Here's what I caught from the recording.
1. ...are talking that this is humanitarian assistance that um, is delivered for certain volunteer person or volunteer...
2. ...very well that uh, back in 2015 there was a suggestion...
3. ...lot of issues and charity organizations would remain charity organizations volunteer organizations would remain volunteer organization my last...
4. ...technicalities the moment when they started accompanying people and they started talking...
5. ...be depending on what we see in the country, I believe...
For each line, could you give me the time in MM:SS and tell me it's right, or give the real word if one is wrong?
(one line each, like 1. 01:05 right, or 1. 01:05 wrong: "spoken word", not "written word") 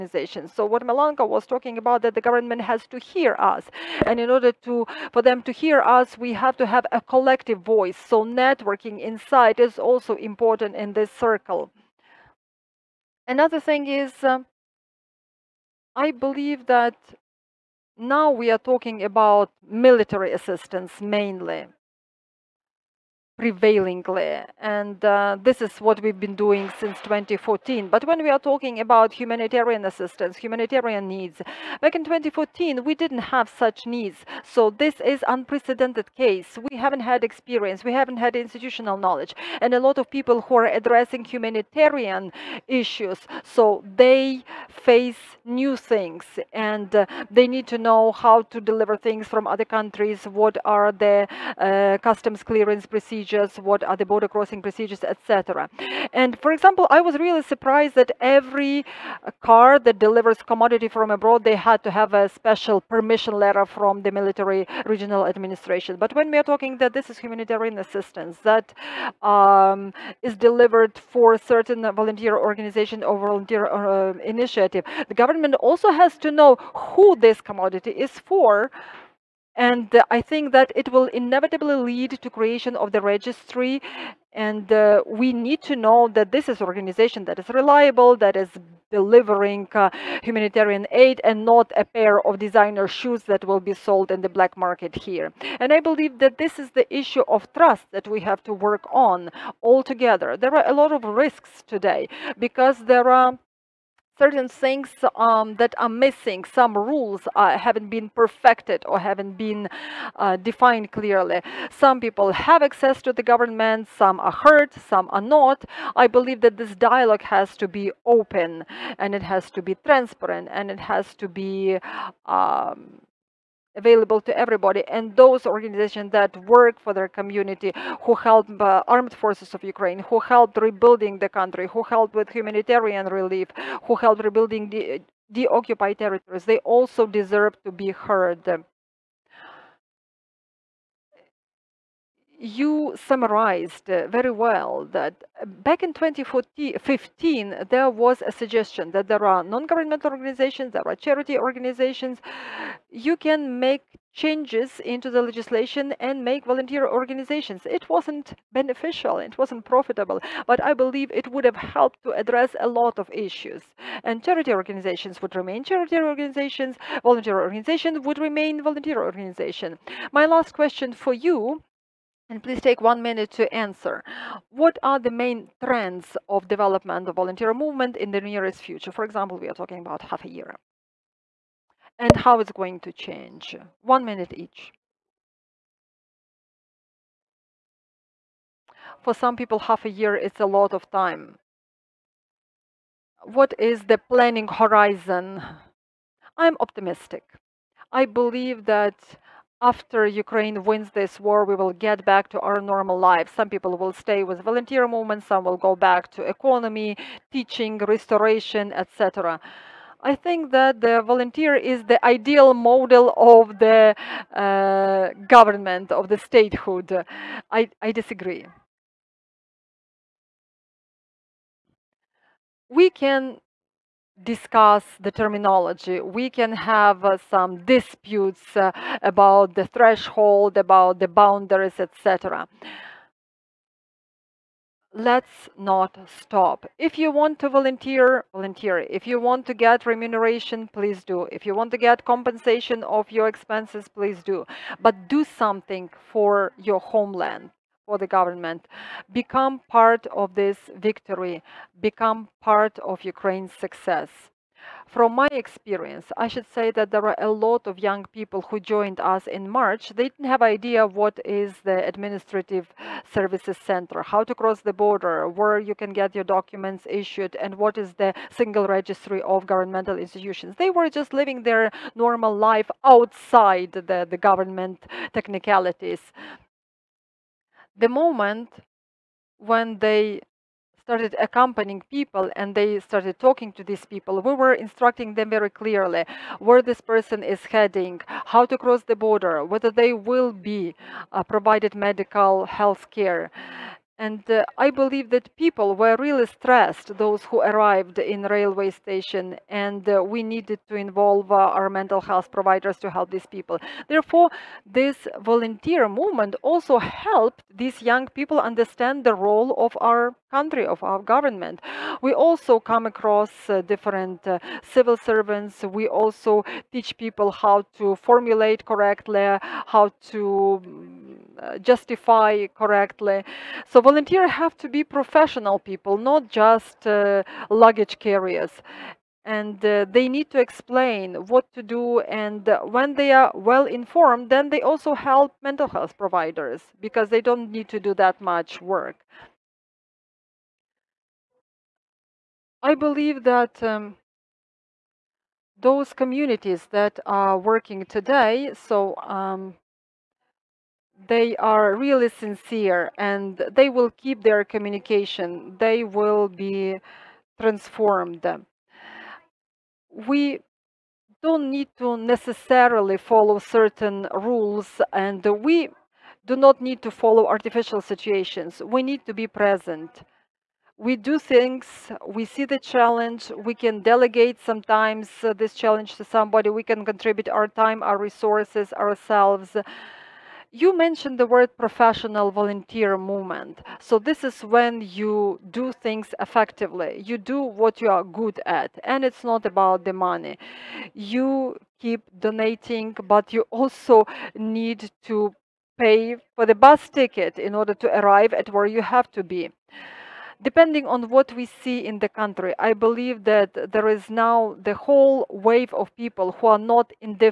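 1. 01:06 wrong: "organization", not "person"
2. 02:24 right
3. 02:42 right
4. 04:35 right
5. 06:39 right.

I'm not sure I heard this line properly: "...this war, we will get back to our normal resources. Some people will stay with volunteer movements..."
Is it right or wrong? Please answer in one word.
wrong.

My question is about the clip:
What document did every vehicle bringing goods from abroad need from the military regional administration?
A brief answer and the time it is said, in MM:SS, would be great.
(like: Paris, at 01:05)
special permission letter, at 01:02.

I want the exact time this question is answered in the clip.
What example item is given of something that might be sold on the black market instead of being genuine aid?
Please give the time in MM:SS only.
01:32.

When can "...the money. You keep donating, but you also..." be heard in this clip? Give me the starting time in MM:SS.
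06:29.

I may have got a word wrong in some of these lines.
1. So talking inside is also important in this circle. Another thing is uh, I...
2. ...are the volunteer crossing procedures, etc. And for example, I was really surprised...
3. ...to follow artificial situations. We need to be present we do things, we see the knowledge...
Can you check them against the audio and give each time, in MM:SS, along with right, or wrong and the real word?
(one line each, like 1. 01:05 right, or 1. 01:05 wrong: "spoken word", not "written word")
1. 00:07 wrong: "networking", not "talking"
2. 00:53 wrong: "border", not "volunteer"
3. 06:06 wrong: "challenge", not "knowledge".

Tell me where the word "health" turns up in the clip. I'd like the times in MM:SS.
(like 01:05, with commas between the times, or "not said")
04:52, 05:02, 05:35.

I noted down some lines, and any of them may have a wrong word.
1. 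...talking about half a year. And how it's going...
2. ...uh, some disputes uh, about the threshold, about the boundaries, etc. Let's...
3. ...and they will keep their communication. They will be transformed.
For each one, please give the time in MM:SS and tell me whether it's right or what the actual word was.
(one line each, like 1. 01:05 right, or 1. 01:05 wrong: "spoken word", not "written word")
1. 02:59 right
2. 03:47 right
3. 05:52 right.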